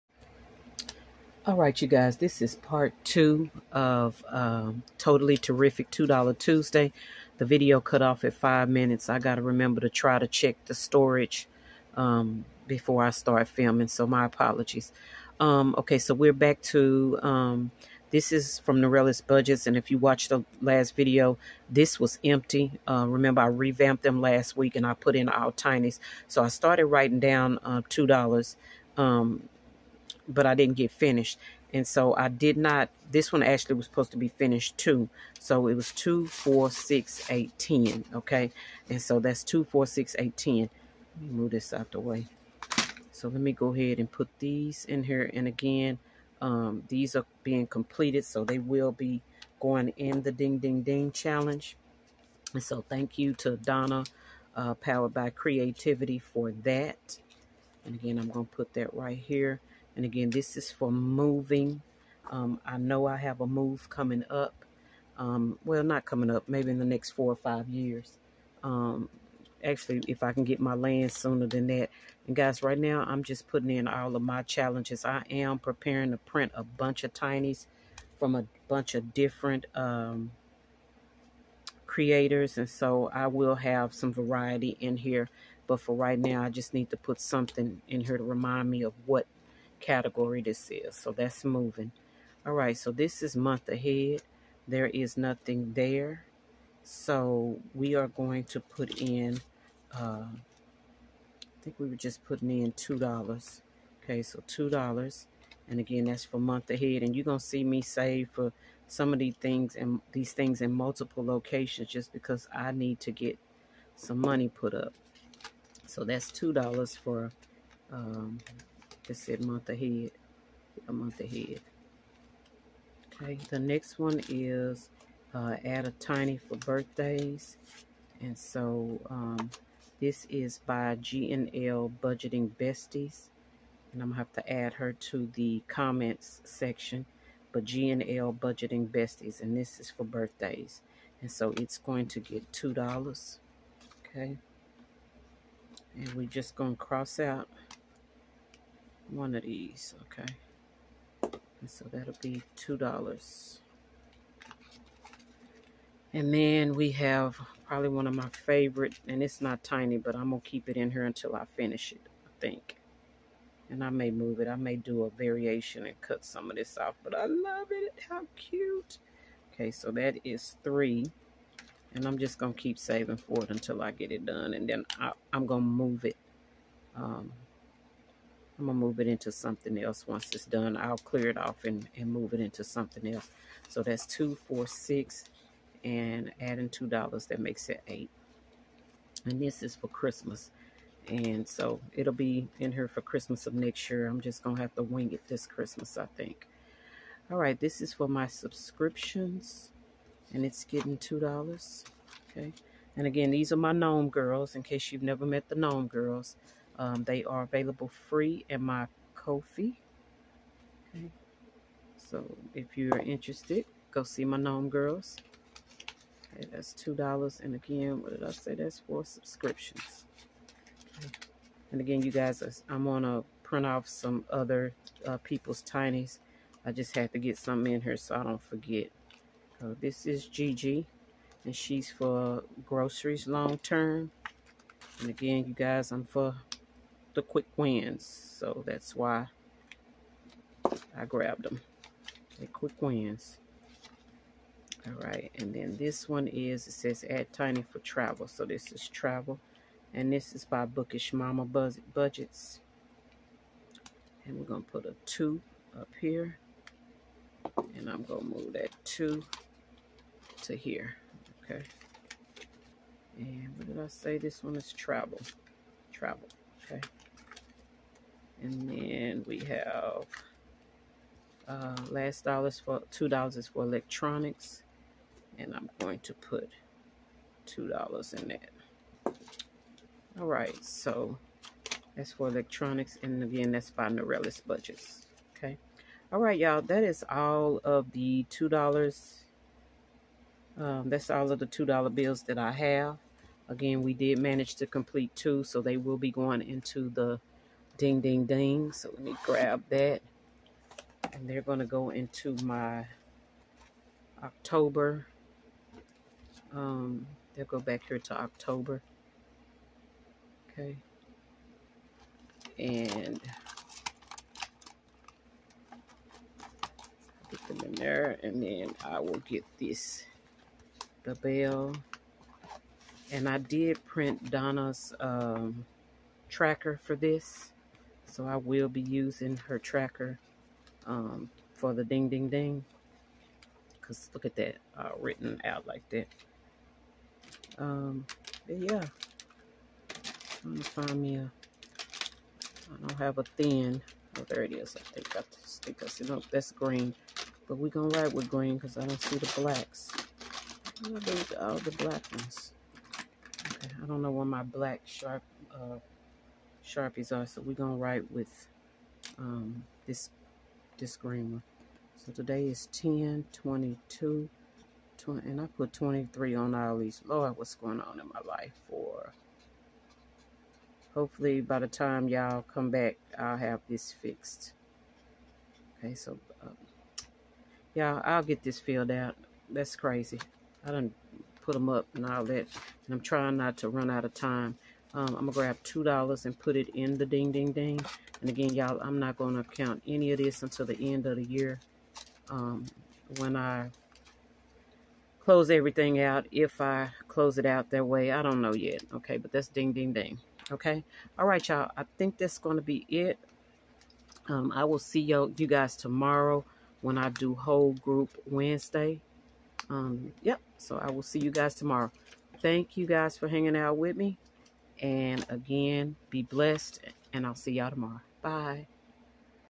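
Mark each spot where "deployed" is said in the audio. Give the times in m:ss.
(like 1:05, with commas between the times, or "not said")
not said.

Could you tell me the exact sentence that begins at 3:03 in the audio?
So that's two, four, six, and adding $2, that makes it 8 And this is for Christmas.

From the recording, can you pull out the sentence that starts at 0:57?
And again, I'm going to put that right here.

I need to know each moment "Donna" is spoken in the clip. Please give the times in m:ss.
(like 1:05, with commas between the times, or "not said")
0:53, 5:24.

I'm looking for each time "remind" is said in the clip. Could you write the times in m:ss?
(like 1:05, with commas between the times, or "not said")
1:28.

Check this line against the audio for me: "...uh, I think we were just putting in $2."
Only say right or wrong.
right.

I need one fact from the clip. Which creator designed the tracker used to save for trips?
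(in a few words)
Bookish Mama Budgets.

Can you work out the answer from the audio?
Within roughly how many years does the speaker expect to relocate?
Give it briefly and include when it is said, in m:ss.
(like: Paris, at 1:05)
4 or 5, at 1:07.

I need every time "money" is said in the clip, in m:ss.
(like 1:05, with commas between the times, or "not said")
1:54.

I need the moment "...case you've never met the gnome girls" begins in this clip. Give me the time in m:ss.
3:24.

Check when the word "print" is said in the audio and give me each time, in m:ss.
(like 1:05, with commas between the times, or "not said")
1:16, 3:43, 5:23.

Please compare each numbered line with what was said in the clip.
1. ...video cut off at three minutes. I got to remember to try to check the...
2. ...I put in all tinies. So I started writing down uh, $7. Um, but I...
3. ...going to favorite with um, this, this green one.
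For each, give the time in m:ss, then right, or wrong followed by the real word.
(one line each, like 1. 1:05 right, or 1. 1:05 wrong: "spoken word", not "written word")
1. 0:07 wrong: "five", not "three"
2. 0:24 wrong: "2", not "7"
3. 5:57 wrong: "write", not "favorite".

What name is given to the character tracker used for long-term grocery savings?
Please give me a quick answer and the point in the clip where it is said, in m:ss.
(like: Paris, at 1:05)
Gigi, at 3:50.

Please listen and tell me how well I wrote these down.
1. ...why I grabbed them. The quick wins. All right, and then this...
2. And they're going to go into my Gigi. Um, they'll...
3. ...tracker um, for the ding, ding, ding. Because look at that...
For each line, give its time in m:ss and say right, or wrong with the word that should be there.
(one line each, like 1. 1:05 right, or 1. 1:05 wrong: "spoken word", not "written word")
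1. 3:58 right
2. 5:01 wrong: "October", not "Gigi"
3. 5:29 right.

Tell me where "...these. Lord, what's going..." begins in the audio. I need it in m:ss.
6:06.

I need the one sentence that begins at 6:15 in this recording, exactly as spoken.
Okay, so, um, y'all, I'll get this filled out.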